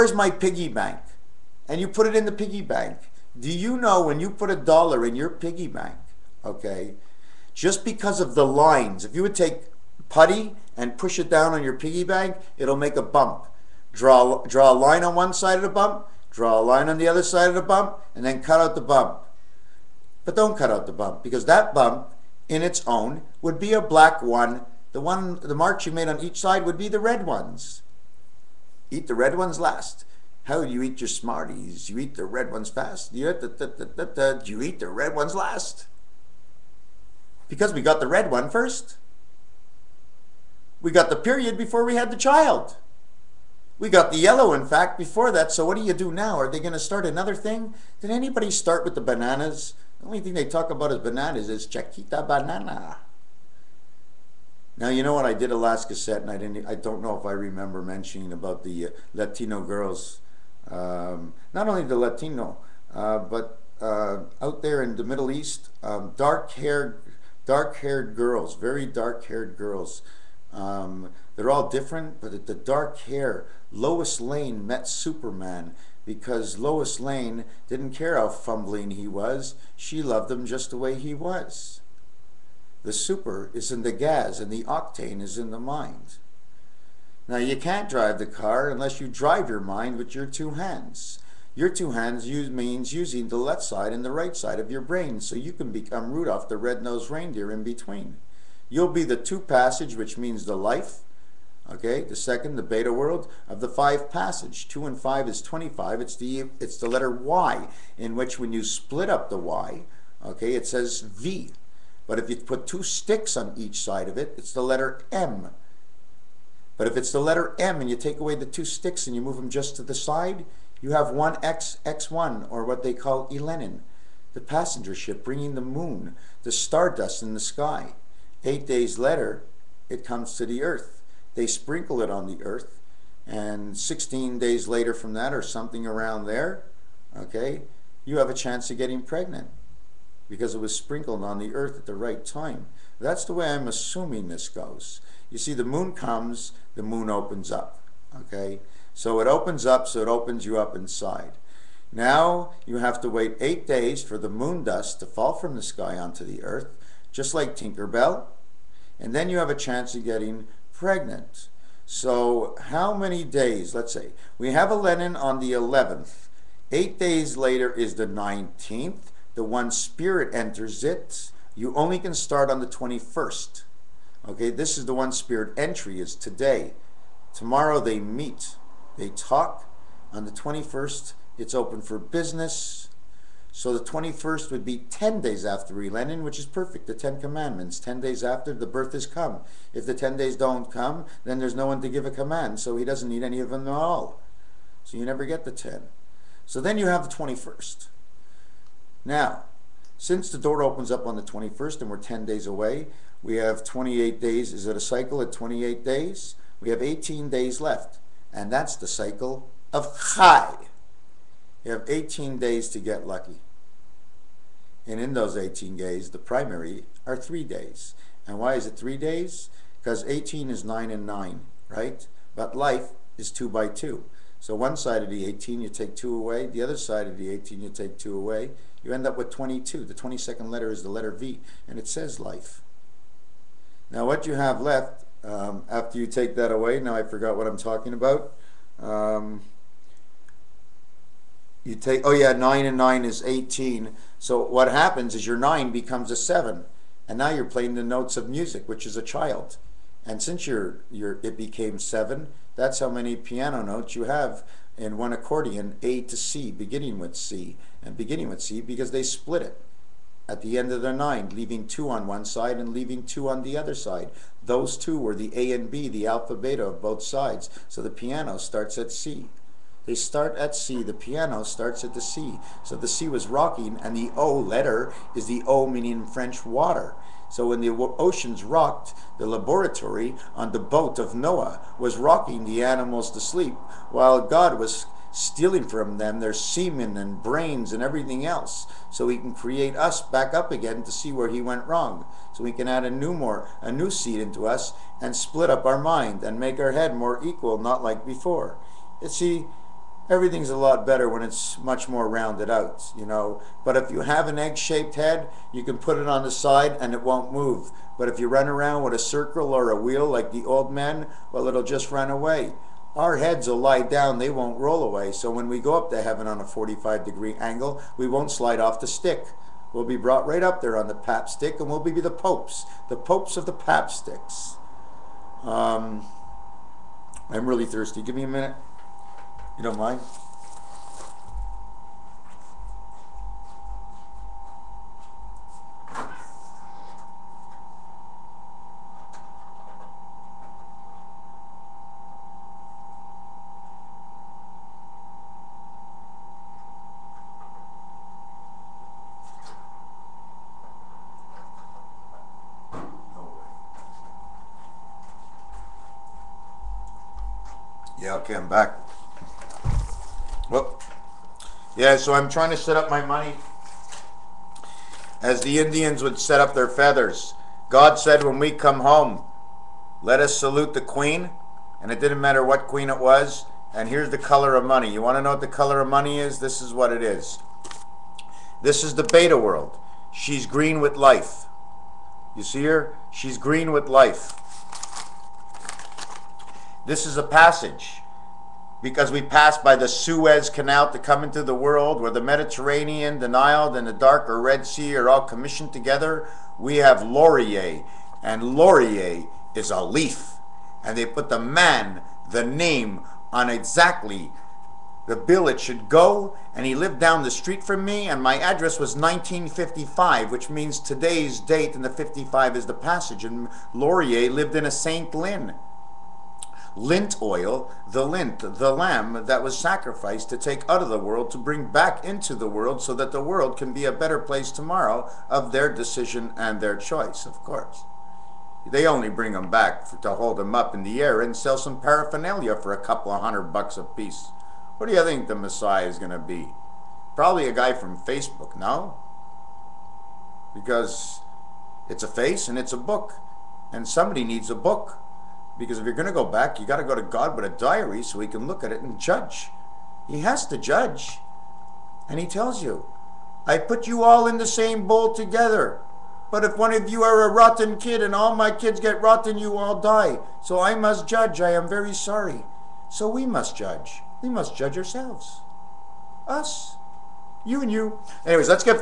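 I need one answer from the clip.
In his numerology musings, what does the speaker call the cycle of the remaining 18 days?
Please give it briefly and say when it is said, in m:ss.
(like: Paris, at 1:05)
Chai, at 3:30.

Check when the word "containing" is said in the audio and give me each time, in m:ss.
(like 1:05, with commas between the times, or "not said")
not said.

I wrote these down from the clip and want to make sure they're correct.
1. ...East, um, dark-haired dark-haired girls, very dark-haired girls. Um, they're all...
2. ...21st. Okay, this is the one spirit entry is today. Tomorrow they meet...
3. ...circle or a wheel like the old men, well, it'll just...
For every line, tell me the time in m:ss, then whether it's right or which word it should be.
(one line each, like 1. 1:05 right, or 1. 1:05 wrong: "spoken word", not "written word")
1. 1:05 right
2. 2:52 right
3. 5:08 right.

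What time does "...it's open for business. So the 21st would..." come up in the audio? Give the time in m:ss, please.
3:01.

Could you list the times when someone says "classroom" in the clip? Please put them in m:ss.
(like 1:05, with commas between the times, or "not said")
not said.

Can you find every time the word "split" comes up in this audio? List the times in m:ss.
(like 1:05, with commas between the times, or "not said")
1:48, 4:19, 4:55.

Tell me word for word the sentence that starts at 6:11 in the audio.
And it didn't matter what queen it was.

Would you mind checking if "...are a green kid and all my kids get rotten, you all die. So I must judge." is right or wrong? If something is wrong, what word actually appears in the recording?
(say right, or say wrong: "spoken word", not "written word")
wrong: "rotten", not "green".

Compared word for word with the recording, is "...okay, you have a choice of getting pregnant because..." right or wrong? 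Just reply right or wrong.
wrong.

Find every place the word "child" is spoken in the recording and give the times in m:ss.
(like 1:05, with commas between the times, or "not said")
0:42, 4:09.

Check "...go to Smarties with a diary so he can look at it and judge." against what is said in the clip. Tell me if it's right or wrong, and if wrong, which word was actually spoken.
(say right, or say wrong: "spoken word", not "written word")
wrong: "God", not "Smarties".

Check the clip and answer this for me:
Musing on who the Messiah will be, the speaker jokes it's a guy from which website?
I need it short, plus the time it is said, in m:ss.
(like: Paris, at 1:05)
Facebook, at 7:17.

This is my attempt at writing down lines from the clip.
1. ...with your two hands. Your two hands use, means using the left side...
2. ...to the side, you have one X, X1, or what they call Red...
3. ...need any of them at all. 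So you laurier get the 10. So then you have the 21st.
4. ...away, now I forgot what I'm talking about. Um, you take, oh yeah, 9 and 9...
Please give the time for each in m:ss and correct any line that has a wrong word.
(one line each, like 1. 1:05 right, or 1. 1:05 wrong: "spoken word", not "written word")
1. 1:29 right
2. 1:59 wrong: "Elenin", not "Red"
3. 3:13 wrong: "never", not "laurier"
4. 3:56 right.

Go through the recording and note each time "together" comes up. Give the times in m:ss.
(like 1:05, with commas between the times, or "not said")
6:35, 7:35.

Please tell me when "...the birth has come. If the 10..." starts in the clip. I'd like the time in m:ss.
3:08.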